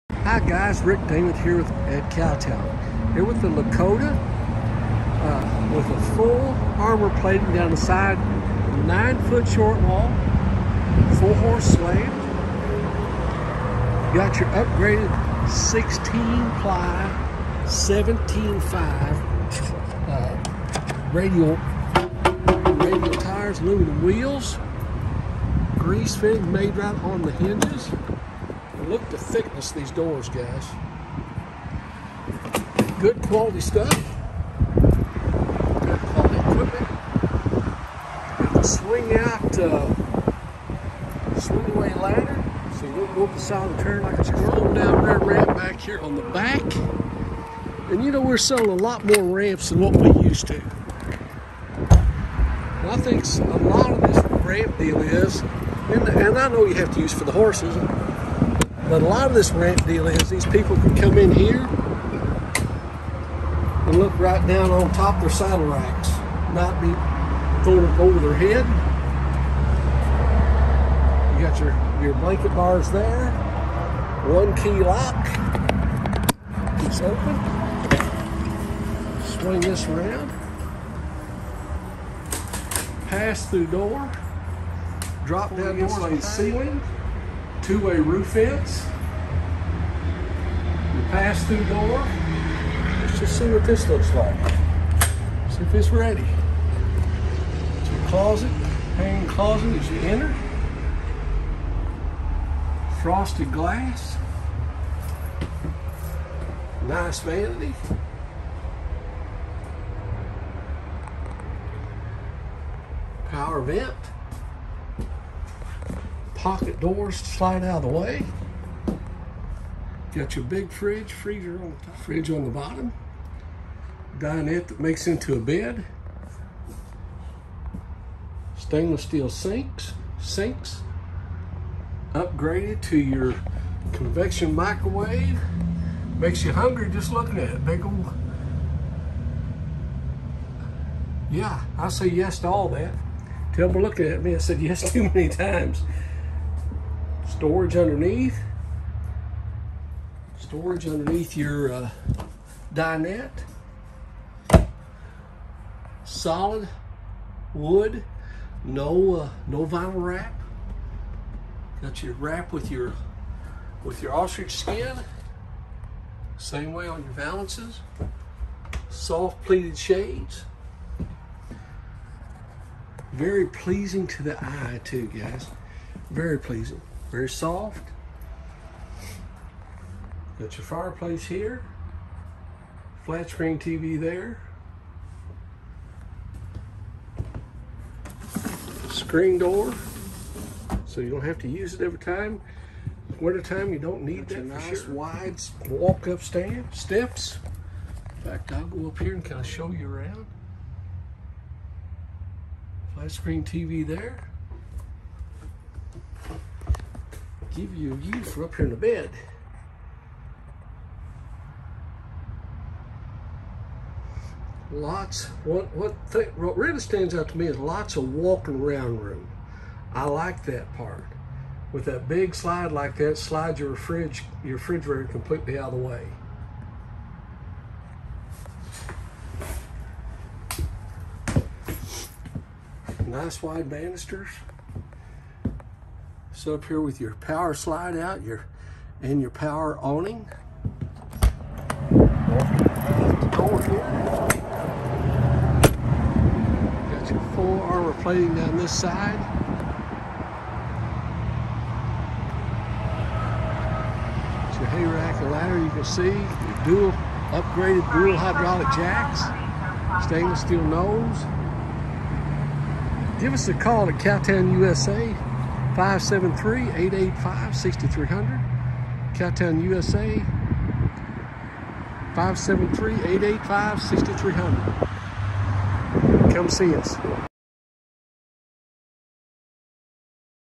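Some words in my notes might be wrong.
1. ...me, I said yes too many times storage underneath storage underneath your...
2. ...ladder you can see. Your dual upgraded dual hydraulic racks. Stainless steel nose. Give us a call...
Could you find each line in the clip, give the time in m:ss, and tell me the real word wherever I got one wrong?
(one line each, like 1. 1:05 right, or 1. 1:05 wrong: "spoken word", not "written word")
1. 2:24 right
2. 4:15 wrong: "jacks", not "racks".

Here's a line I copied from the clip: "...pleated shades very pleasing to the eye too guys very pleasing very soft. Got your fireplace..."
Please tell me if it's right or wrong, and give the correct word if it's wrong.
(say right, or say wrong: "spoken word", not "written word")
right.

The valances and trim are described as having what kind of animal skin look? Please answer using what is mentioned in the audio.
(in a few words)
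Ostrich skin.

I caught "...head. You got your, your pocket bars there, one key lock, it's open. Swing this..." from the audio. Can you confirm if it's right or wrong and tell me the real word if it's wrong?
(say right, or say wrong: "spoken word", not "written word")
wrong: "blanket", not "pocket".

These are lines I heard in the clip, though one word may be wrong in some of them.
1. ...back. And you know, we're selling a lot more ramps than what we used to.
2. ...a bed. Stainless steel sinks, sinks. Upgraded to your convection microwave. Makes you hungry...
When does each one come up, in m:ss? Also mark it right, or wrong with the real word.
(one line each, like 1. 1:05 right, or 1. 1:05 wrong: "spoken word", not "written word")
1. 0:46 right
2. 2:05 right.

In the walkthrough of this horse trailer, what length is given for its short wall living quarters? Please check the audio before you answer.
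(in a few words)
9 foot.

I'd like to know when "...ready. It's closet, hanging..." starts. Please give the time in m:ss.
1:35.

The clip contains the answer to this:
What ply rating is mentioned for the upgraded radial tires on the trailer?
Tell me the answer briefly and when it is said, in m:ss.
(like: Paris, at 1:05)
16 ply, at 0:15.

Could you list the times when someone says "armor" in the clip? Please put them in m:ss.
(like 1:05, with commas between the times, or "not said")
0:06, 4:07.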